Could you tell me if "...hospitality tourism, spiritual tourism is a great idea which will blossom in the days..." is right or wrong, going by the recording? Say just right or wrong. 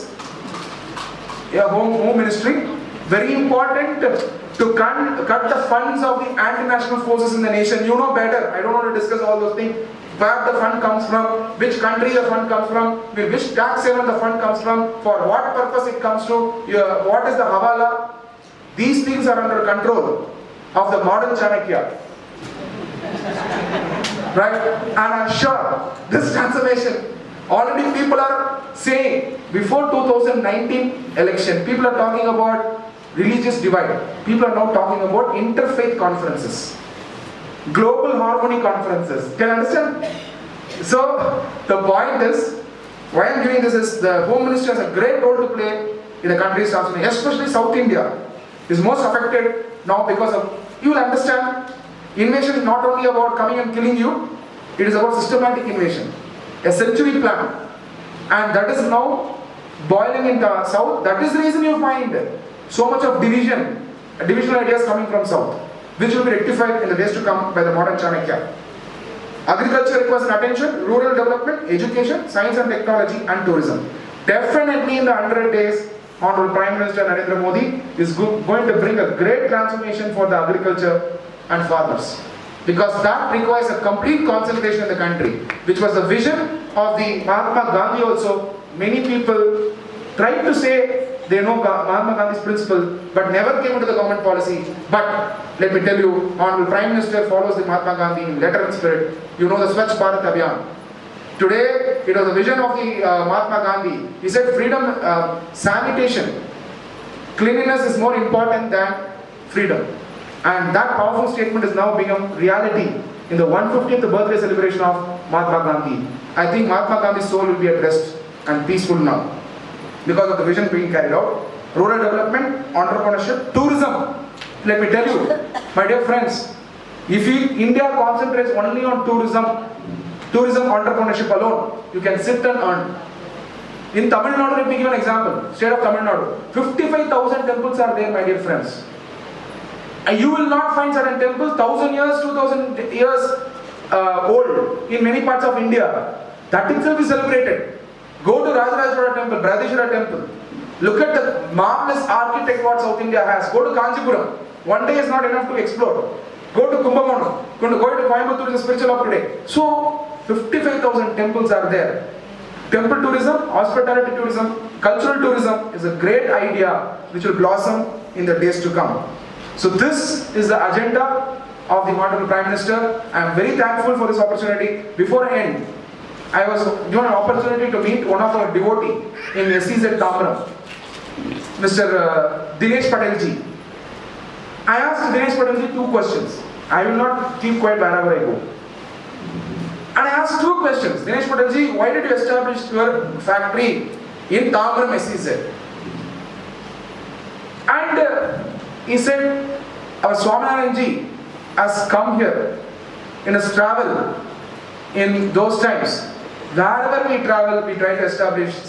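wrong.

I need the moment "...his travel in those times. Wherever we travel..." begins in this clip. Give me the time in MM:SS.
03:23.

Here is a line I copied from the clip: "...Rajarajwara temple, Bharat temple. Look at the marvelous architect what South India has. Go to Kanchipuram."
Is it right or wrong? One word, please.
wrong.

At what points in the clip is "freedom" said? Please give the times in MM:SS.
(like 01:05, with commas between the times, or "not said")
01:44, 01:49.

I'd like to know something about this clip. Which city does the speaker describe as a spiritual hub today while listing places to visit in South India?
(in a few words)
Coimbatore.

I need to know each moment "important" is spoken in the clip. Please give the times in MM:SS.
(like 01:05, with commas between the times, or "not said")
00:03, 01:48.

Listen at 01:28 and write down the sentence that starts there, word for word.
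Many people tried to say they know Mahatma Gandhi's principle, but never came into the government policy.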